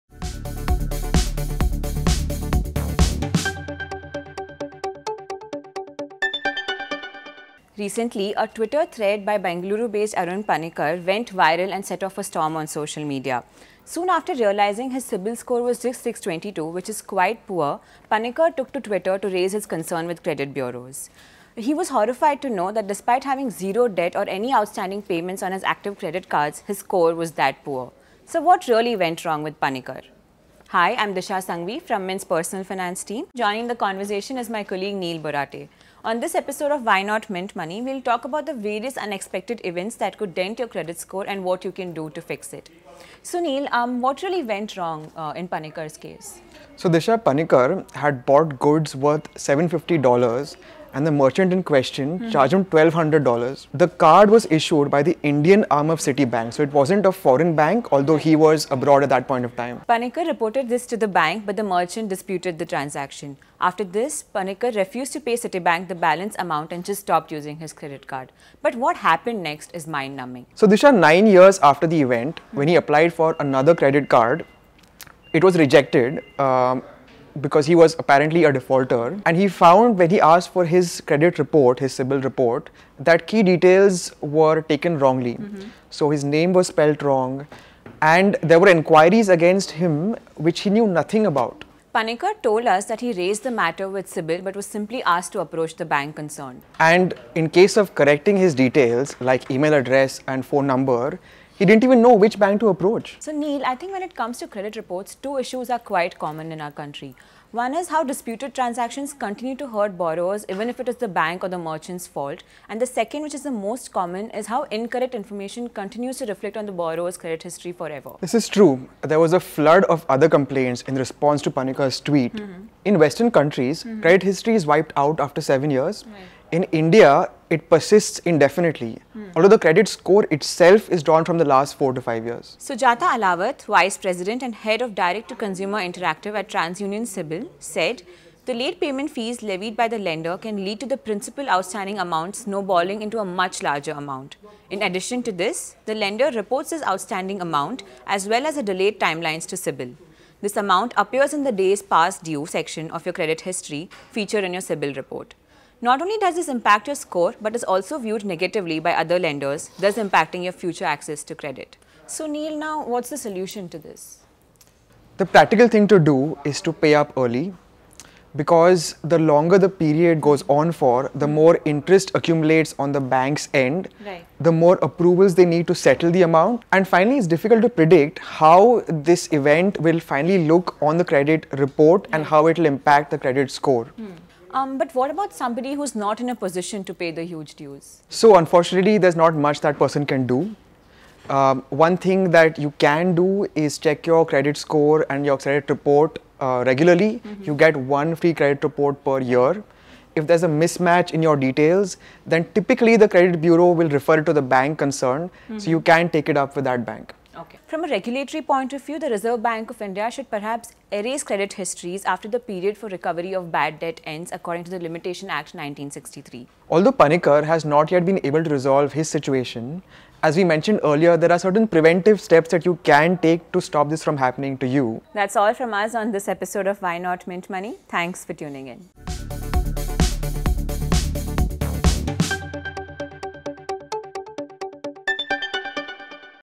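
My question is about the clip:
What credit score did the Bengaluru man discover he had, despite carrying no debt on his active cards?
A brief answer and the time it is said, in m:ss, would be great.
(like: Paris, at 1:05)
622, at 0:16.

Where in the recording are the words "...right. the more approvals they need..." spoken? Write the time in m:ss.
2:54.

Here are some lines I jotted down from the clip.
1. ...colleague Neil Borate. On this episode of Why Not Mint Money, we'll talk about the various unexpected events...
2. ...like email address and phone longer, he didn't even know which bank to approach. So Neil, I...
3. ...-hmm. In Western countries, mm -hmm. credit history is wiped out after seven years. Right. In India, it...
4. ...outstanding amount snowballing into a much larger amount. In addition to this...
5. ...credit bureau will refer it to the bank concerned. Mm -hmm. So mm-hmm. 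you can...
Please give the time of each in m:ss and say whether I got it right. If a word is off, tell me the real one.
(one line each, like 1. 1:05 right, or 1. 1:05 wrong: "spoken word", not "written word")
1. 0:34 right
2. 1:39 wrong: "number", not "longer"
3. 2:02 right
4. 2:21 right
5. 3:23 right.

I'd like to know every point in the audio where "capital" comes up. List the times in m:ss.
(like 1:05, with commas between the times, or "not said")
not said.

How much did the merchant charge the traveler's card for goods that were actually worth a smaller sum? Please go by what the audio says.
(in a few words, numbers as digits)
$1,200.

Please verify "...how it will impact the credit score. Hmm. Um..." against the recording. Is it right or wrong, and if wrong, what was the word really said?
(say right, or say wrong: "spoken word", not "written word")
right.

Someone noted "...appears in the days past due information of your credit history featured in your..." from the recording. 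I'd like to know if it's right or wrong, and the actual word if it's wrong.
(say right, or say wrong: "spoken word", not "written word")
wrong: "section", not "information".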